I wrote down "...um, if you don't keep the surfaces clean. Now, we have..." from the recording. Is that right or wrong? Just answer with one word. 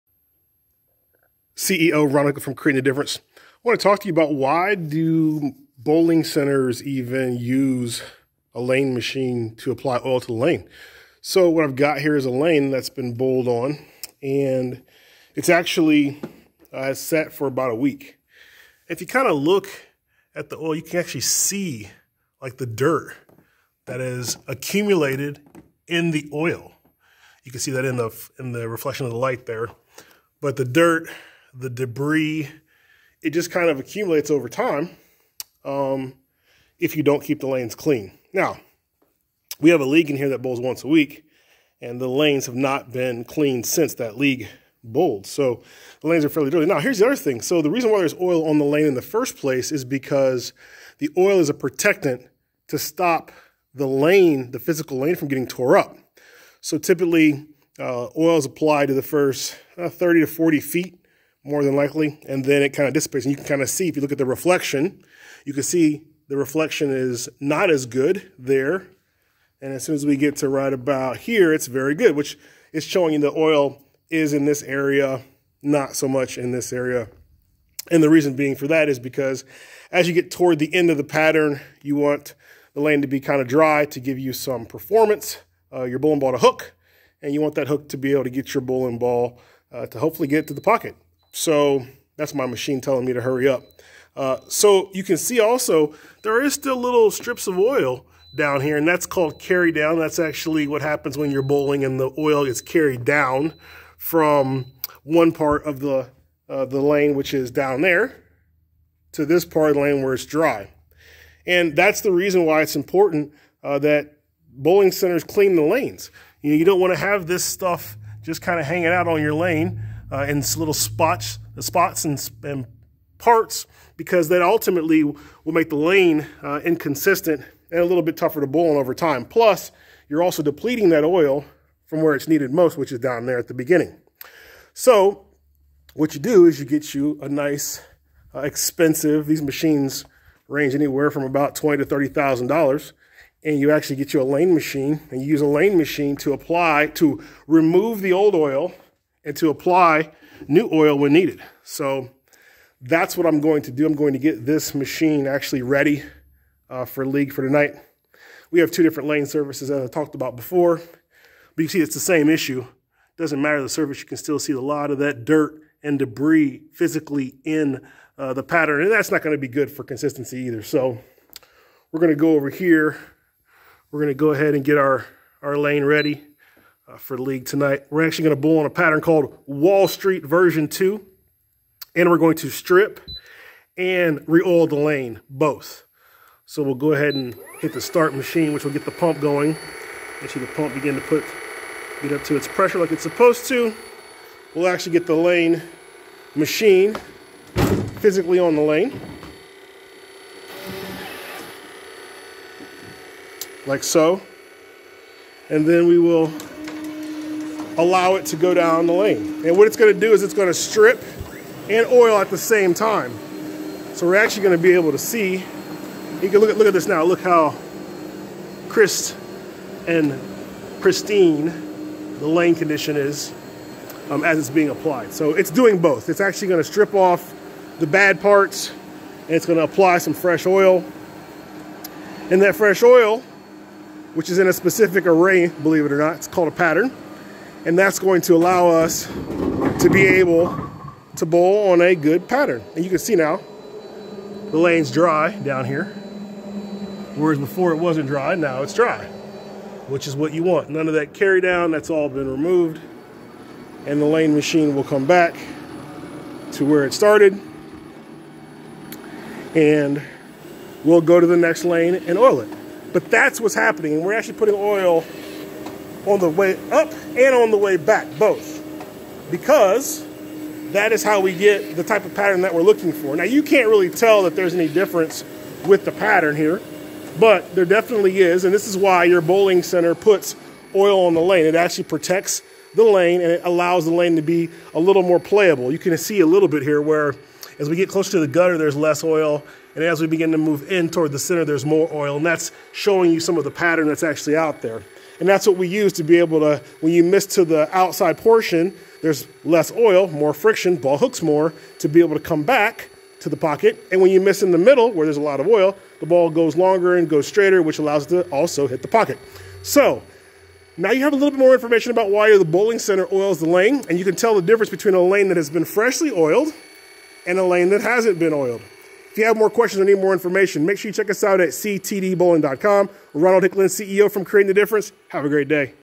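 wrong.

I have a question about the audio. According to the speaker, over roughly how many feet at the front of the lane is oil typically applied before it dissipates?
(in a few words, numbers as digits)
30 to 40 feet.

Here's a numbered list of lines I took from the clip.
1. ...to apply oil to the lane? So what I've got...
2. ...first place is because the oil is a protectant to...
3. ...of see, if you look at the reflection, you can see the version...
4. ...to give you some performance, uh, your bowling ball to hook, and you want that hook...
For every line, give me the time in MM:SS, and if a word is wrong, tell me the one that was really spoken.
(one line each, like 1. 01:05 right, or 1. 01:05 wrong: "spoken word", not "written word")
1. 00:09 right
2. 00:49 right
3. 01:03 wrong: "reflection", not "version"
4. 01:23 right.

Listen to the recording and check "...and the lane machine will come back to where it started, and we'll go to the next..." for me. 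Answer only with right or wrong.
right.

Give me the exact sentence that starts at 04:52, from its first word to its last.
And that's showing you some of the pattern that's actually out there.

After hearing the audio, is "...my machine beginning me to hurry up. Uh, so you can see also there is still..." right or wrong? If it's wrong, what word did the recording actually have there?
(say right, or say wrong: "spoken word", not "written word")
wrong: "telling", not "beginning".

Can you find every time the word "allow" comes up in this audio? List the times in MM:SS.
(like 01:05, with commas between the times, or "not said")
03:27, 03:58, 04:43, 05:07.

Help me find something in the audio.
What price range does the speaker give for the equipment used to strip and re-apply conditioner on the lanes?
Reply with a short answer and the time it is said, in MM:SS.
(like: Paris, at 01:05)
$20,000 to $30,000, at 02:21.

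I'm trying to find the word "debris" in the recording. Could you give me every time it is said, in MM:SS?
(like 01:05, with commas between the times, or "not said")
00:31, 02:45.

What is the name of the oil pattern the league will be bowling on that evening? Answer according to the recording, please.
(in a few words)
Wall Street version 2.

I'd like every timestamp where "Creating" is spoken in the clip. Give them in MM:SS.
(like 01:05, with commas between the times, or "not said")
00:02, 05:24.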